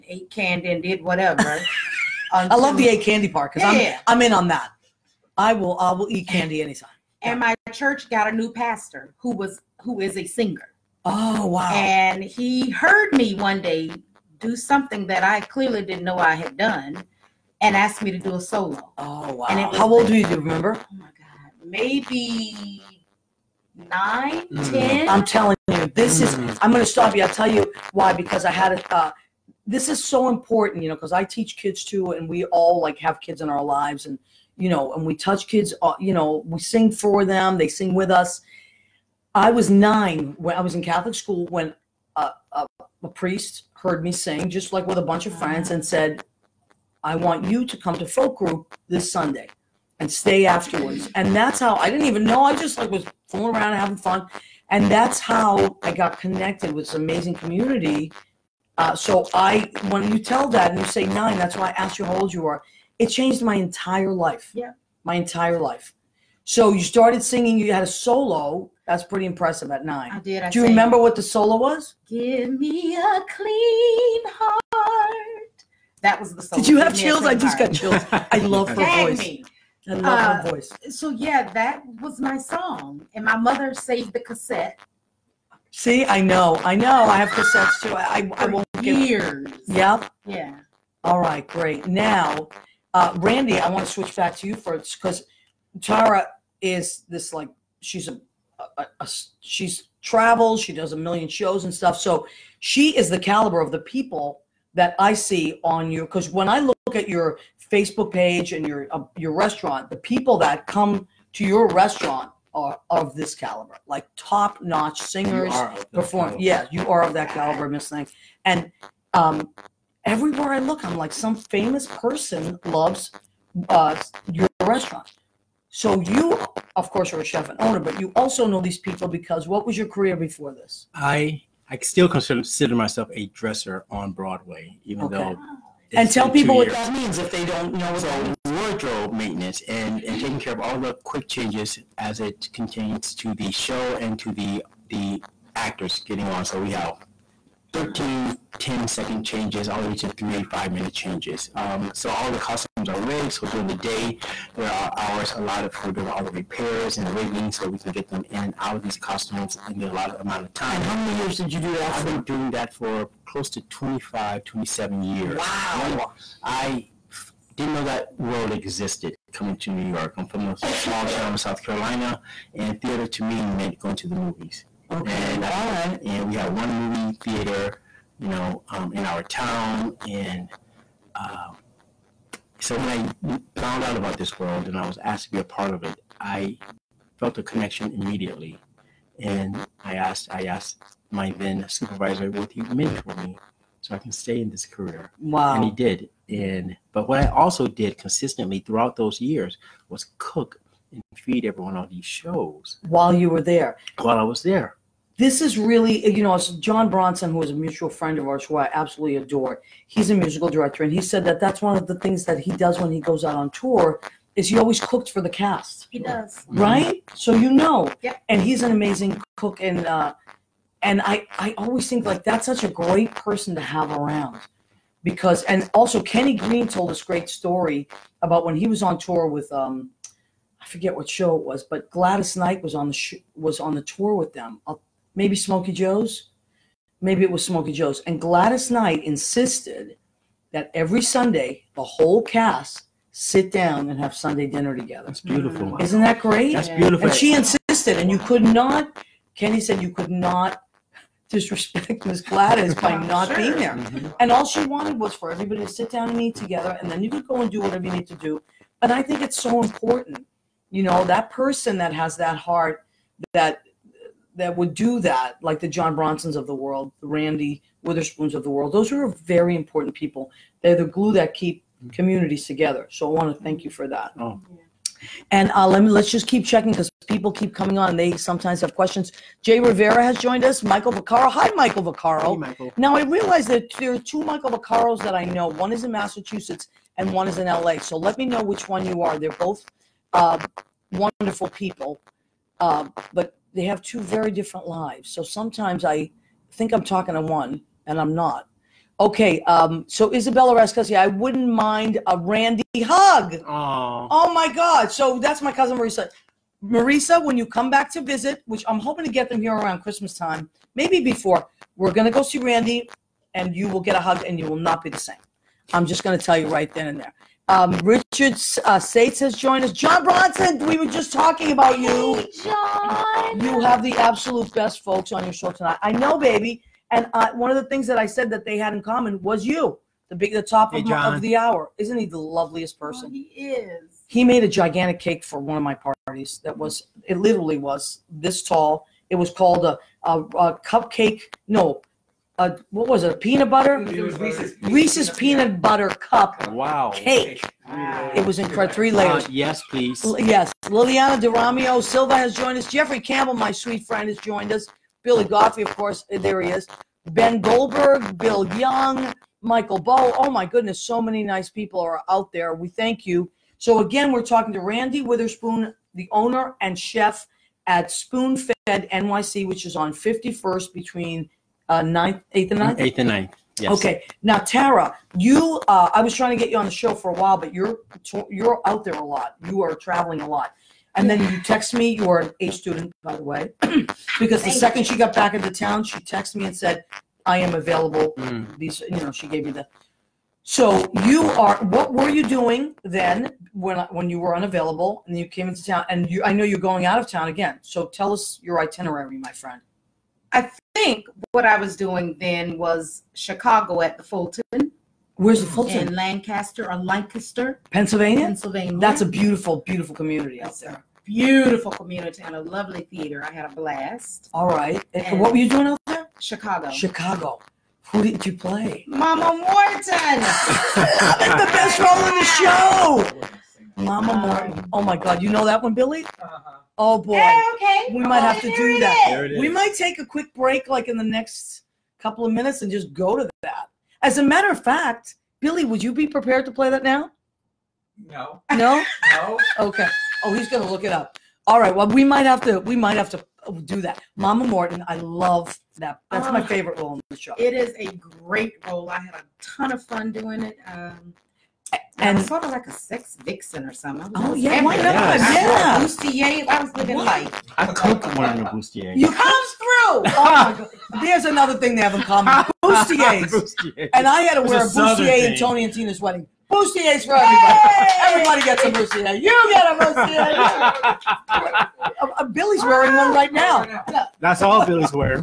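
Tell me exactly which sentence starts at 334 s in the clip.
He made a gigantic cake for one of my parties.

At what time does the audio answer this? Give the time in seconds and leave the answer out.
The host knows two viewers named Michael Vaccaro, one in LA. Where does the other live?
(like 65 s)
285 s.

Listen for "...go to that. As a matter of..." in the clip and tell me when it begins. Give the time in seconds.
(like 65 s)
432 s.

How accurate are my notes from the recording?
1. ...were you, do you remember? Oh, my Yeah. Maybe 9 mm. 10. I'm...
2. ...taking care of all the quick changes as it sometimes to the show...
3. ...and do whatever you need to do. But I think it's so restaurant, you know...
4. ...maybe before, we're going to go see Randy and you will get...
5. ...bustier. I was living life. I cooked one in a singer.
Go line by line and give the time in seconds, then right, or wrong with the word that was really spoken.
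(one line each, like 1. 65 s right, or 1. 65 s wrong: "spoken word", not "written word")
1. 20 s wrong: "God", not "Yeah"
2. 140 s wrong: "continues", not "sometimes"
3. 257 s wrong: "important", not "restaurant"
4. 310 s right
5. 455 s wrong: "bustier", not "singer".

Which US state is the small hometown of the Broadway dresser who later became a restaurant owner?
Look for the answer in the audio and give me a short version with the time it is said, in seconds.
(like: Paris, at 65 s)
South Carolina, at 171 s.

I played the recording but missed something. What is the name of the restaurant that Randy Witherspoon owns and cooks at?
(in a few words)
Spoon Fed NYC.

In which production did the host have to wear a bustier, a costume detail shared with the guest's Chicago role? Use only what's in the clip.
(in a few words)
Tony and Tina's Wedding.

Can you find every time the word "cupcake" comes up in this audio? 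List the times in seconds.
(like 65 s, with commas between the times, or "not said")
340 s.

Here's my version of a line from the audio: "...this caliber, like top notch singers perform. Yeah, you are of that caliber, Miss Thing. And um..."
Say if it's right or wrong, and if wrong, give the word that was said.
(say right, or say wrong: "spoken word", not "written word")
right.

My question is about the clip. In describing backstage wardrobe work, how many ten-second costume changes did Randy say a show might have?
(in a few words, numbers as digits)
13.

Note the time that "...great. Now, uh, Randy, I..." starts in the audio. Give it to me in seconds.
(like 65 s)
91 s.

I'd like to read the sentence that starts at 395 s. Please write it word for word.
And you, I know you're going out of town again.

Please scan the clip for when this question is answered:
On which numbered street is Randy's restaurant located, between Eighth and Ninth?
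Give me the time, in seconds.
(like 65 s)
369 s.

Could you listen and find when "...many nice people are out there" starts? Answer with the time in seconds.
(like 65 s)
360 s.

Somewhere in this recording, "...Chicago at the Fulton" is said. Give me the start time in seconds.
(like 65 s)
403 s.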